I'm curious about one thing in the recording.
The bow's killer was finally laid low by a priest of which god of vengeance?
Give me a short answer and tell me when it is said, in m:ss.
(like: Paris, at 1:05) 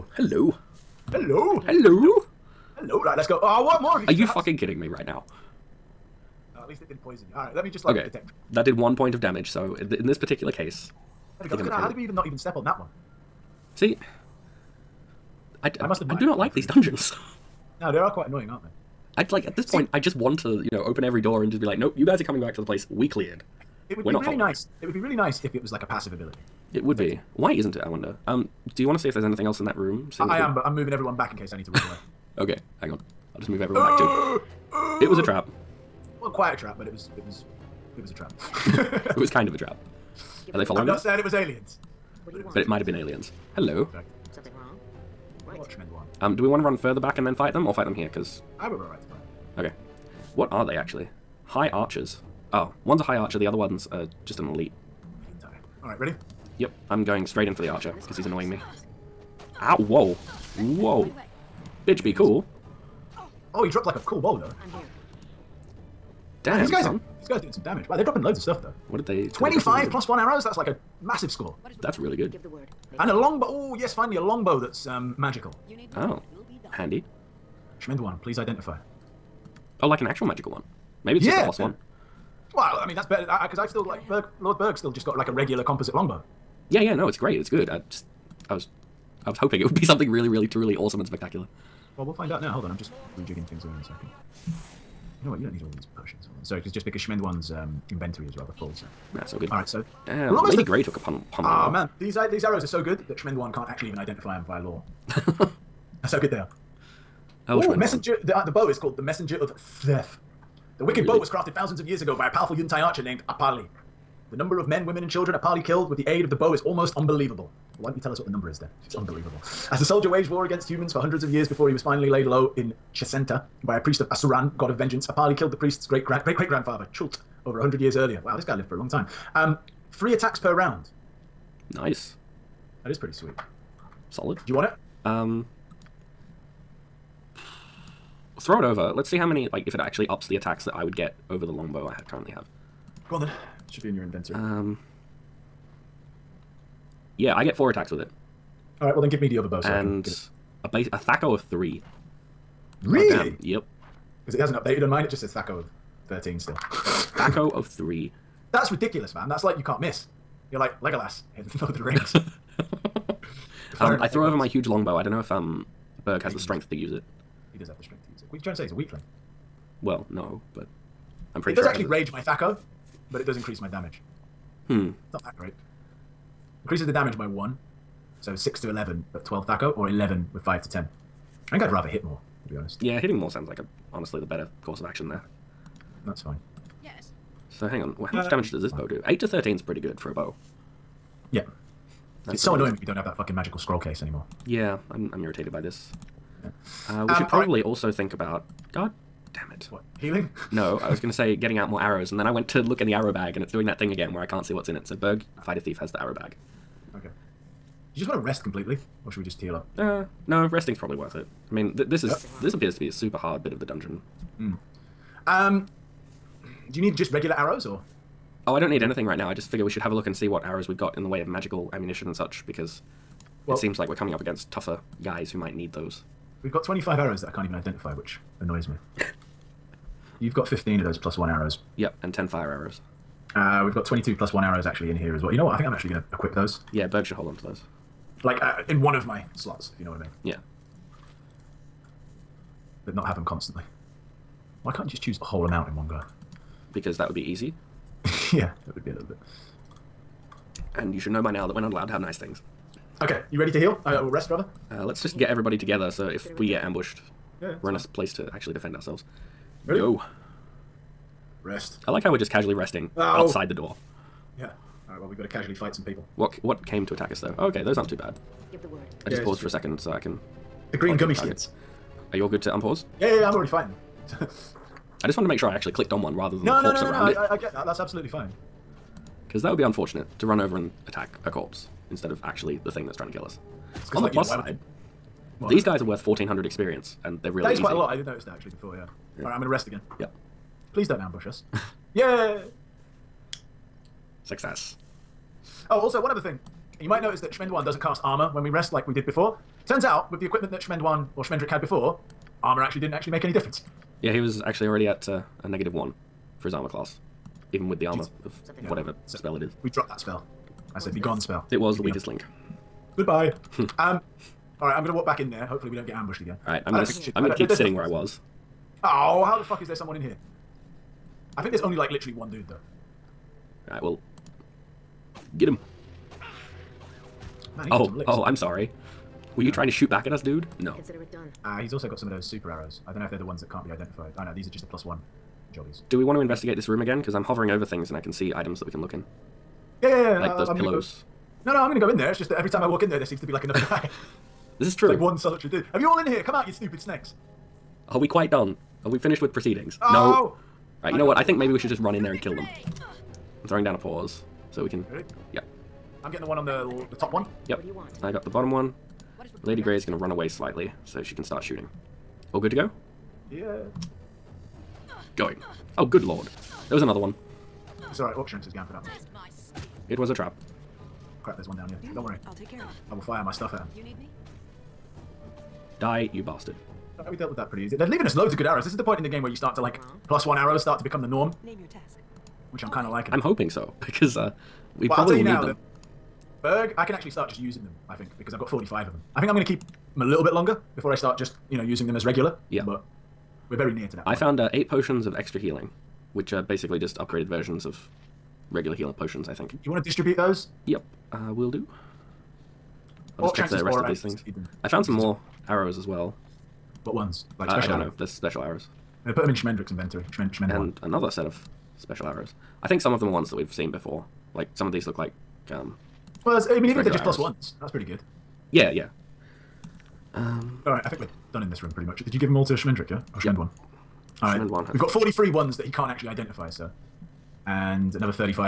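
Asuran, at 2:04.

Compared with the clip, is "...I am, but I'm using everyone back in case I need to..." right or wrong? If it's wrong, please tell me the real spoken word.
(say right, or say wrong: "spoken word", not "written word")
wrong: "moving", not "using".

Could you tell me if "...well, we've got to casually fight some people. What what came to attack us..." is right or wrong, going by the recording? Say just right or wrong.
right.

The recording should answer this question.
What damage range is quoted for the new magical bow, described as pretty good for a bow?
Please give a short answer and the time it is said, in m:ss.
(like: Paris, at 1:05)
8 to 13, at 3:09.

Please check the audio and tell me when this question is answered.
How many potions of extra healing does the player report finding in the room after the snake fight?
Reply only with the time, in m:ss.
6:34.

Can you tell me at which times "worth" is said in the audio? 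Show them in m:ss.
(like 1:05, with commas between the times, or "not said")
3:30, 4:45.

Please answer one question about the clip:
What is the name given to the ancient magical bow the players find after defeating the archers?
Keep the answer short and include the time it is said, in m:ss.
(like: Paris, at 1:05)
Messenger of Sseth, at 1:49.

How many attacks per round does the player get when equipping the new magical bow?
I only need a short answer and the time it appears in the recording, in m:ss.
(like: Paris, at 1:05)
4, at 2:27.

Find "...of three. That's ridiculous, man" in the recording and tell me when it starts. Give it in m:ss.
2:37.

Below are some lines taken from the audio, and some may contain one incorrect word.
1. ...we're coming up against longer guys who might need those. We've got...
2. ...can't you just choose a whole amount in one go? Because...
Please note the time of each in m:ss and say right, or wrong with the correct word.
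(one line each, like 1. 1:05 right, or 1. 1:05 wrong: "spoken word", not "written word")
1. 3:43 wrong: "tougher", not "longer"
2. 4:04 right.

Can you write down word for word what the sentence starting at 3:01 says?
I think I'd rather hit more, to be honest.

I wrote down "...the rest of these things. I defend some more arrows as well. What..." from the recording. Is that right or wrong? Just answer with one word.
wrong.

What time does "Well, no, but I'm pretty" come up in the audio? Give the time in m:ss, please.
2:49.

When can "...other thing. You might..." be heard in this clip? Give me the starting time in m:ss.
4:56.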